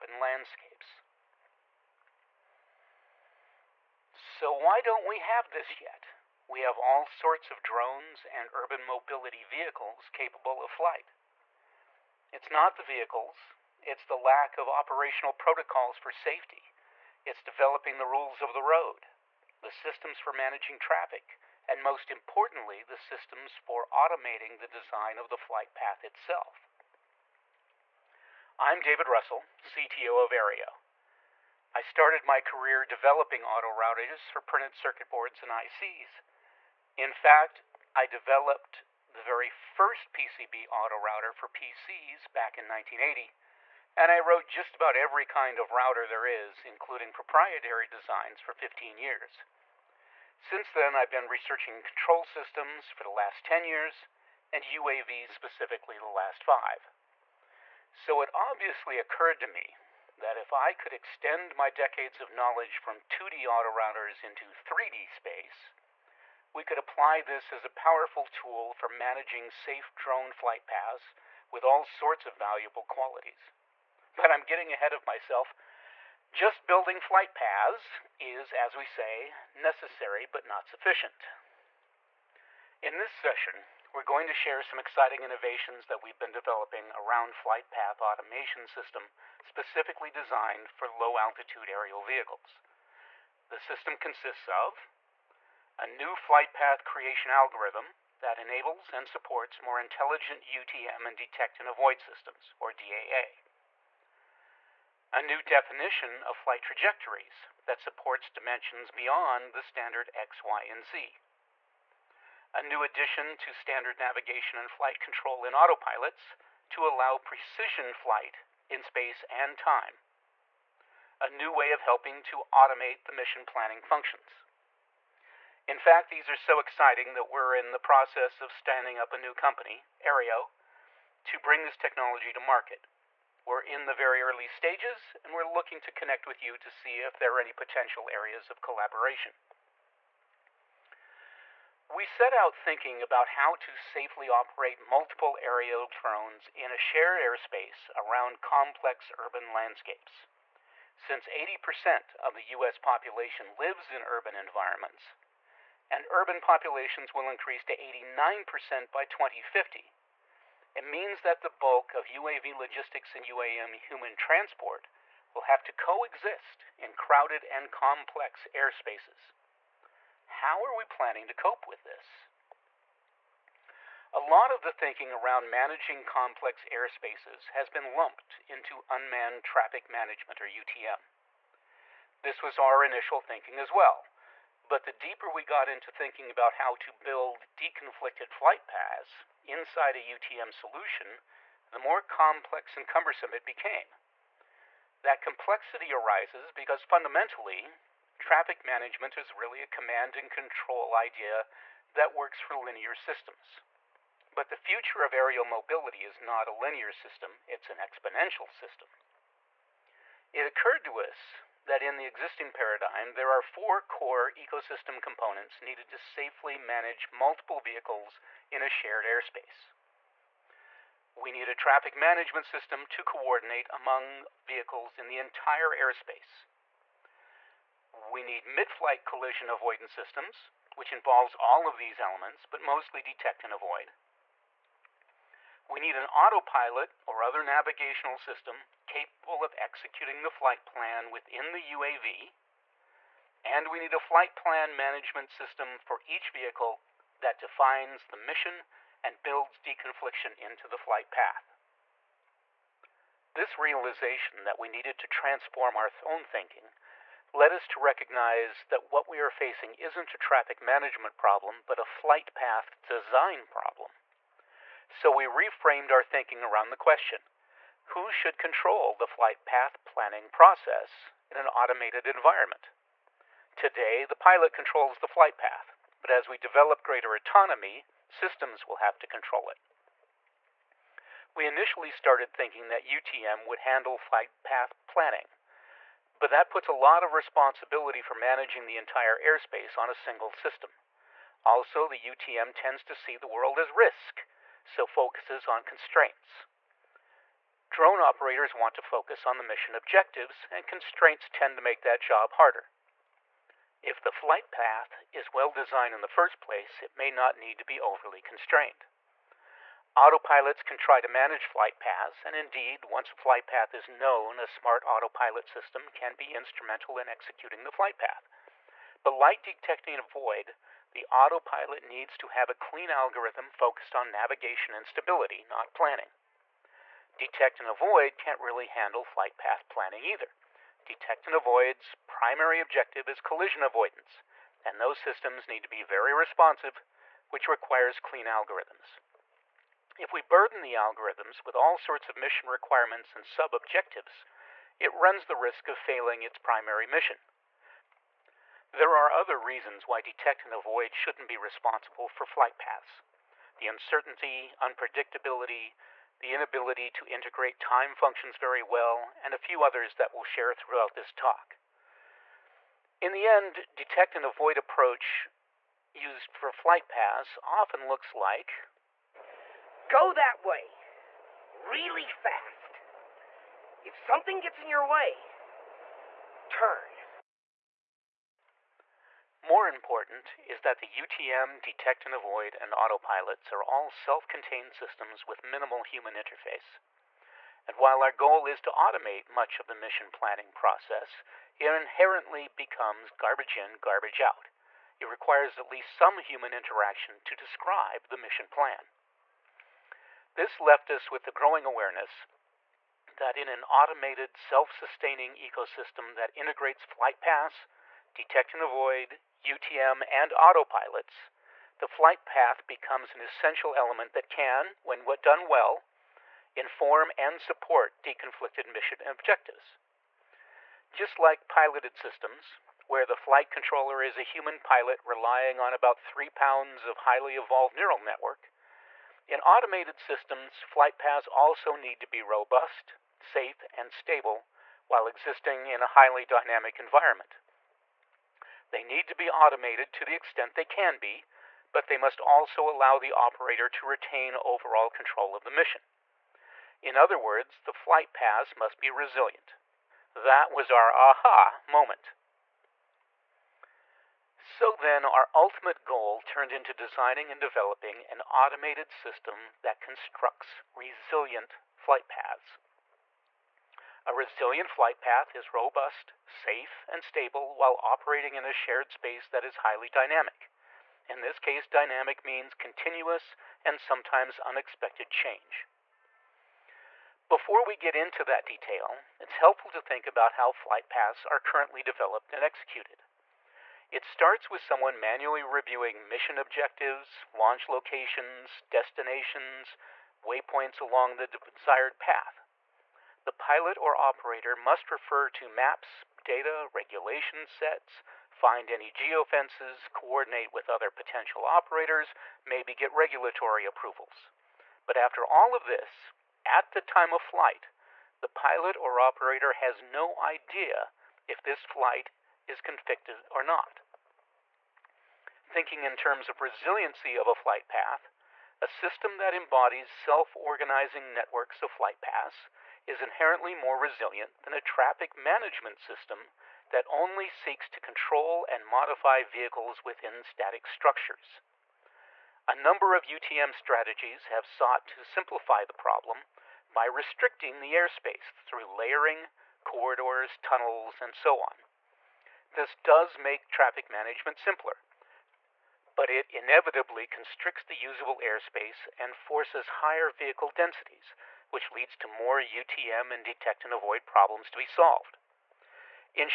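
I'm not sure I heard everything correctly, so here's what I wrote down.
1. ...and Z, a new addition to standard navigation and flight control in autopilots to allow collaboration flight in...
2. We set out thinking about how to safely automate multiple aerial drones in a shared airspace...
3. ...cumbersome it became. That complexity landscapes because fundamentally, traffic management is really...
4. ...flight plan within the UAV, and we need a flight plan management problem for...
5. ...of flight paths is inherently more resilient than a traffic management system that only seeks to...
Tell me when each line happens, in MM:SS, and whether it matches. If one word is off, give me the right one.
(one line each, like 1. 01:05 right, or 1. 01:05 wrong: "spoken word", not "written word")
1. 01:50 wrong: "precision", not "collaboration"
2. 02:21 wrong: "operate", not "automate"
3. 03:12 wrong: "arises", not "landscapes"
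4. 04:00 wrong: "system", not "problem"
5. 08:41 right.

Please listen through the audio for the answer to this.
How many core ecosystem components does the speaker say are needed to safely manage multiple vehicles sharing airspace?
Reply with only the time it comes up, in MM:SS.
03:33.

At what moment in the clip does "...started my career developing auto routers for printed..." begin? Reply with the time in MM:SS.
00:31.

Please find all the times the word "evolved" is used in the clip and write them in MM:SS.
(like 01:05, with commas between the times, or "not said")
07:07.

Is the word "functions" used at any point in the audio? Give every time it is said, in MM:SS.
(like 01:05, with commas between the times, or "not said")
02:03, 05:57.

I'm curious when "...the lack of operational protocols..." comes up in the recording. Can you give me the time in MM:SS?
00:14.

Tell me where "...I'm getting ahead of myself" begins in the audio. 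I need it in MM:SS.
01:14.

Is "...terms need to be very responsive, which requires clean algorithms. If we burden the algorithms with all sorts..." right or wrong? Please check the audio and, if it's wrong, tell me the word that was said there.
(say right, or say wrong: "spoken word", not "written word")
wrong: "systems", not "terms".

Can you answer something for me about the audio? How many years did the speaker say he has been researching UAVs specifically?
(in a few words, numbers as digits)
5.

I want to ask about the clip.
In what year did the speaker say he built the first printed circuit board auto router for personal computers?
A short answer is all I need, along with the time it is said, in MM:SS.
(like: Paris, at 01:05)
1980, at 00:42.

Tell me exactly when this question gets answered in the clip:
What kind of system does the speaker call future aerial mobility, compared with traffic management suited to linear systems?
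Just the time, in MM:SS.
03:27.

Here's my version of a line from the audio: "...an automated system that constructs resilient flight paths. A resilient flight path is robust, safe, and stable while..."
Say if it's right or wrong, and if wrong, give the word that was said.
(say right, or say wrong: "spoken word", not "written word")
right.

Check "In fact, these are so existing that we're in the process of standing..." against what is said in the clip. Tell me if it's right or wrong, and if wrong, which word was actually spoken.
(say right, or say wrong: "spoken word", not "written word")
wrong: "exciting", not "existing".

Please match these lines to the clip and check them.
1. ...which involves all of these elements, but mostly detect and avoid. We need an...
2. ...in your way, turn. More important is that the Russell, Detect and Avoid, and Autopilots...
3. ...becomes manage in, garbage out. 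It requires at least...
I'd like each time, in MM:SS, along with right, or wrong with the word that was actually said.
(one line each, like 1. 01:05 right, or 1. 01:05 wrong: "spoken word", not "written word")
1. 03:50 right
2. 06:14 wrong: "UTM", not "Russell"
3. 06:32 wrong: "garbage", not "manage".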